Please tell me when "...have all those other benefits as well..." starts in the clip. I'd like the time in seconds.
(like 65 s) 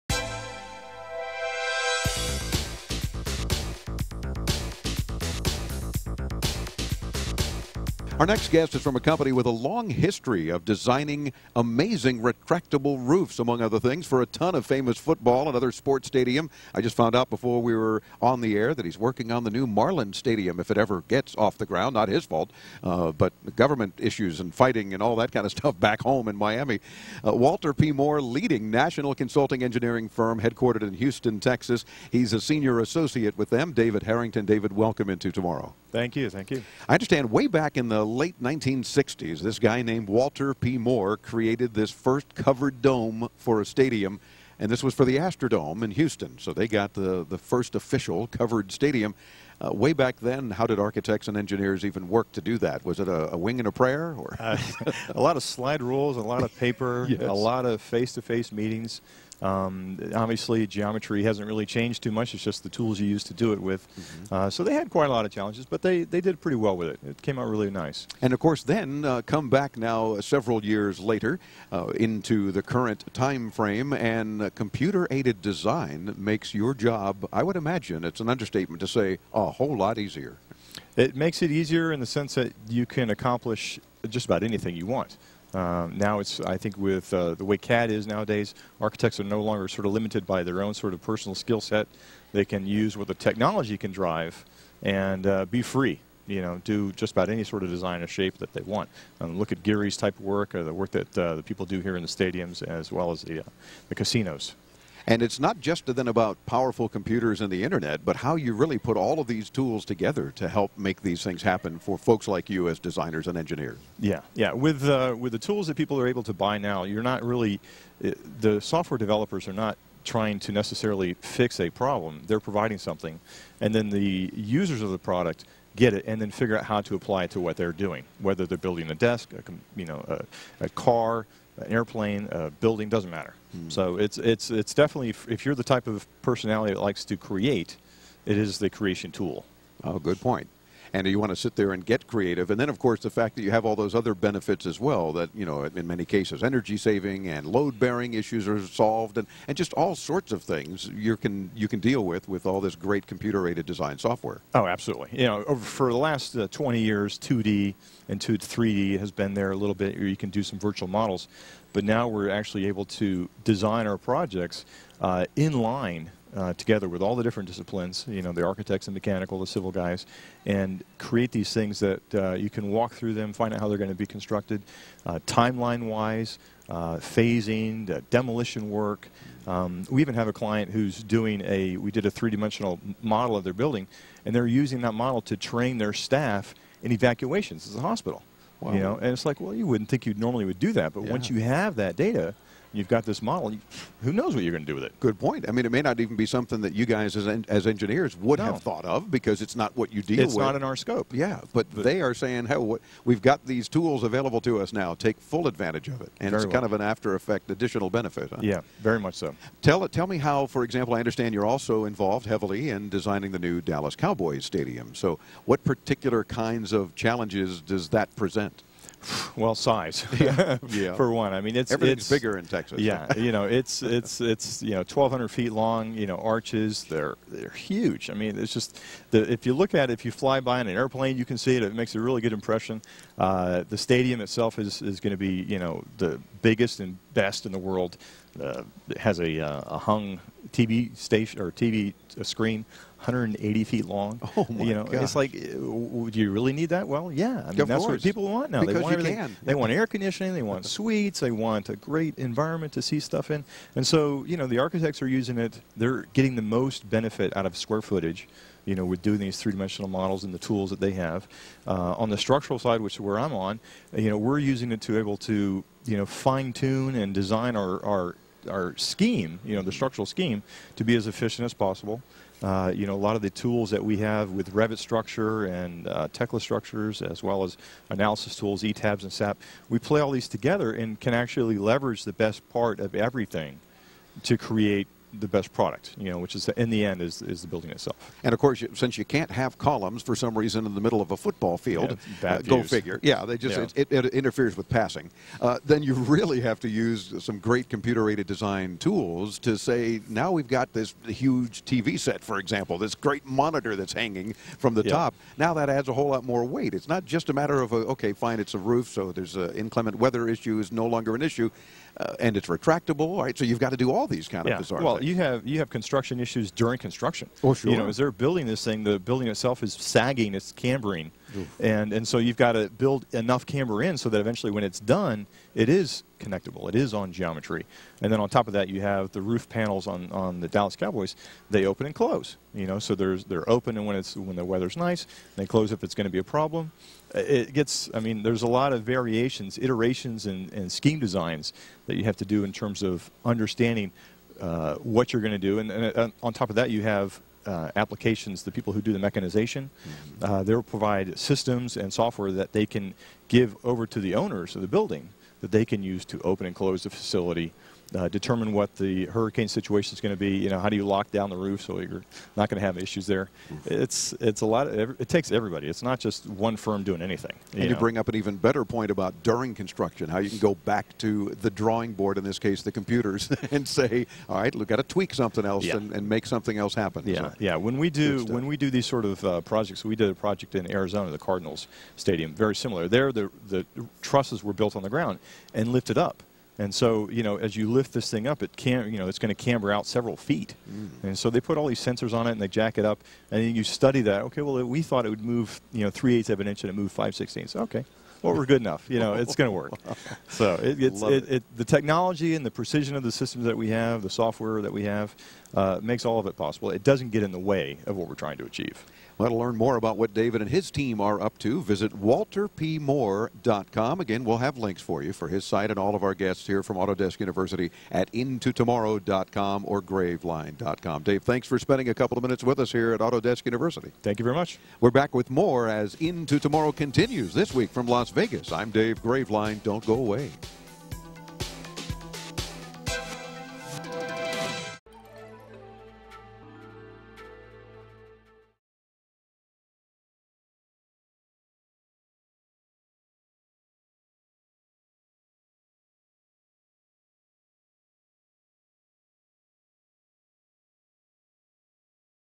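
143 s.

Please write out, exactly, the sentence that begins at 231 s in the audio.
It makes a really good impression.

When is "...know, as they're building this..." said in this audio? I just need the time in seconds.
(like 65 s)
317 s.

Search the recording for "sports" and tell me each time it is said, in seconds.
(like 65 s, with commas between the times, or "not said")
15 s.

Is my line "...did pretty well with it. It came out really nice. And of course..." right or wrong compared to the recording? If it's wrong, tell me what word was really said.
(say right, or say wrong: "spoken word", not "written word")
right.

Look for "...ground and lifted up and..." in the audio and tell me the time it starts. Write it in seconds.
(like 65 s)
384 s.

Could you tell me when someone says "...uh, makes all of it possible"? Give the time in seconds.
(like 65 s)
405 s.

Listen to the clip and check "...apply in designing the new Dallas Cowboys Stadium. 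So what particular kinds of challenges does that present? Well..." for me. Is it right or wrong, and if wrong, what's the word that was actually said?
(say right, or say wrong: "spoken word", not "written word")
wrong: "heavily", not "apply".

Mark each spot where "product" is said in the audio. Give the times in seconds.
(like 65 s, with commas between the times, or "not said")
124 s, 285 s.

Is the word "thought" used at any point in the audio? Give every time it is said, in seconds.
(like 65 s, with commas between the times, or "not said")
198 s, 394 s.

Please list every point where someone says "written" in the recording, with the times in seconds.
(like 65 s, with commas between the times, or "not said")
not said.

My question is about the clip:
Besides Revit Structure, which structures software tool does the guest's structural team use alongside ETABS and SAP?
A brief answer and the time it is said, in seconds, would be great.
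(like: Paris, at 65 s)
Tekla Structures, at 276 s.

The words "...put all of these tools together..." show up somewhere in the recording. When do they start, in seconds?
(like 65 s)
108 s.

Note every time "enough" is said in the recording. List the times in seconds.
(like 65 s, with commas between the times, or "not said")
323 s, 398 s.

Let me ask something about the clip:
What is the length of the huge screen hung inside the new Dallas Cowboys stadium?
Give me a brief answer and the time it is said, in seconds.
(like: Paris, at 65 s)
180 feet, at 242 s.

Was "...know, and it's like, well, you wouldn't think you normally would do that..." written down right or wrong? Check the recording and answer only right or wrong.
right.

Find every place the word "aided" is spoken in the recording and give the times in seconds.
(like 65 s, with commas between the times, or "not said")
75 s, 153 s, 297 s.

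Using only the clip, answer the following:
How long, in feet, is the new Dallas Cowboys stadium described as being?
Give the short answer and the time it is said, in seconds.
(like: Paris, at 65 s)
1,200 feet, at 224 s.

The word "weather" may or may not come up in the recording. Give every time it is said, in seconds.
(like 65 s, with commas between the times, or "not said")
309 s, 334 s.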